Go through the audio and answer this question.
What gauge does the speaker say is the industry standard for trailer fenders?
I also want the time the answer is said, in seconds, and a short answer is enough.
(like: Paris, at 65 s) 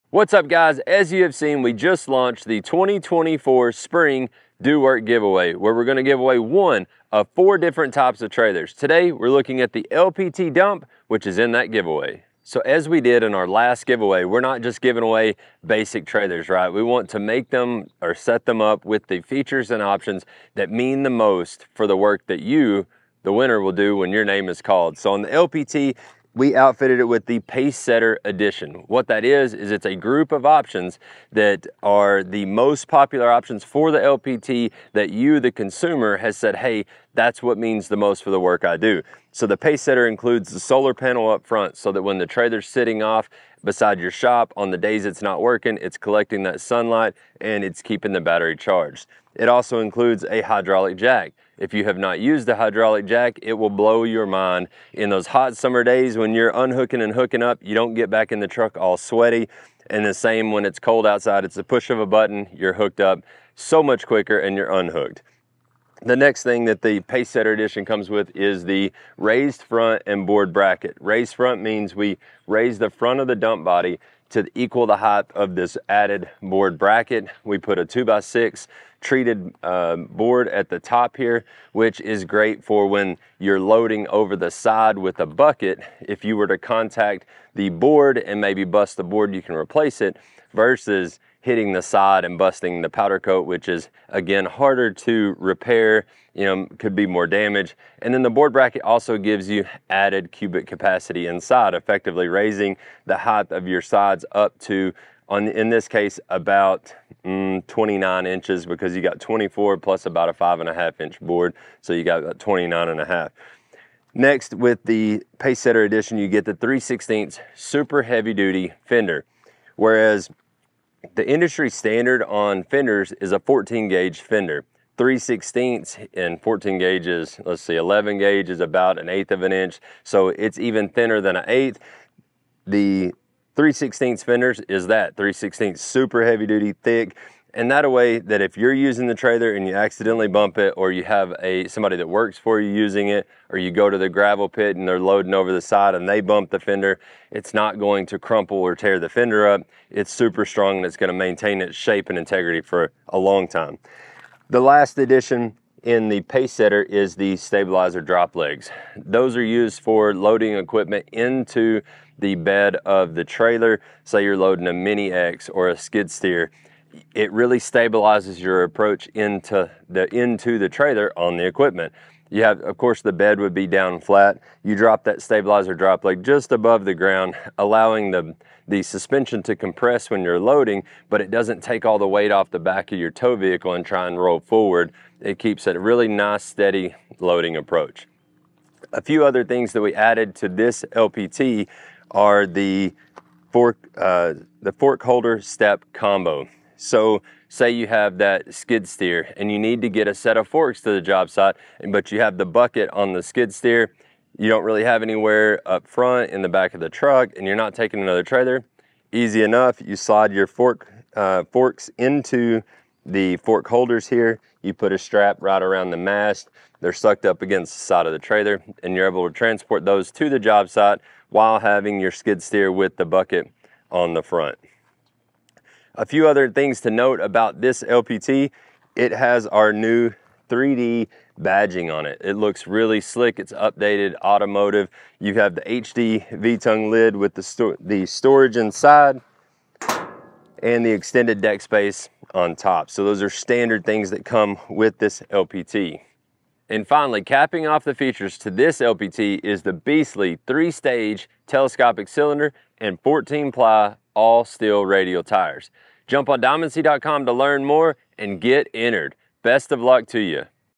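14 gauge, at 123 s.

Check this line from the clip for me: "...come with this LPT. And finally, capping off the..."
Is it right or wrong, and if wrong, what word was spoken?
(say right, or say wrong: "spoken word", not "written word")
right.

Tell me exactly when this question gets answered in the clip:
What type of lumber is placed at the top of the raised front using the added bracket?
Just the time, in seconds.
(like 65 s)
77 s.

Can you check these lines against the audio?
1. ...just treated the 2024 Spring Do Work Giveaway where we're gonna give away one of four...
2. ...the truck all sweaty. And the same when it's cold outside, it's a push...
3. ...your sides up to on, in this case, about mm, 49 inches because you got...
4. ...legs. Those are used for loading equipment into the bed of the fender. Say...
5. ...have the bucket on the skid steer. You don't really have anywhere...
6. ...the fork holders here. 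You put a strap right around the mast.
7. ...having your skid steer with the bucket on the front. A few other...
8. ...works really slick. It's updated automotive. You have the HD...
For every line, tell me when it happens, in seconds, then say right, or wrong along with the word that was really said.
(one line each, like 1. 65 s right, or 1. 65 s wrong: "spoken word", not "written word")
1. 1 s wrong: "launched", not "treated"
2. 58 s right
3. 103 s wrong: "29", not "49"
4. 158 s wrong: "trailer", not "fender"
5. 202 s right
6. 213 s right
7. 221 s right
8. 232 s wrong: "looks", not "works".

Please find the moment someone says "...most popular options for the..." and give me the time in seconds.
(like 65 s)
32 s.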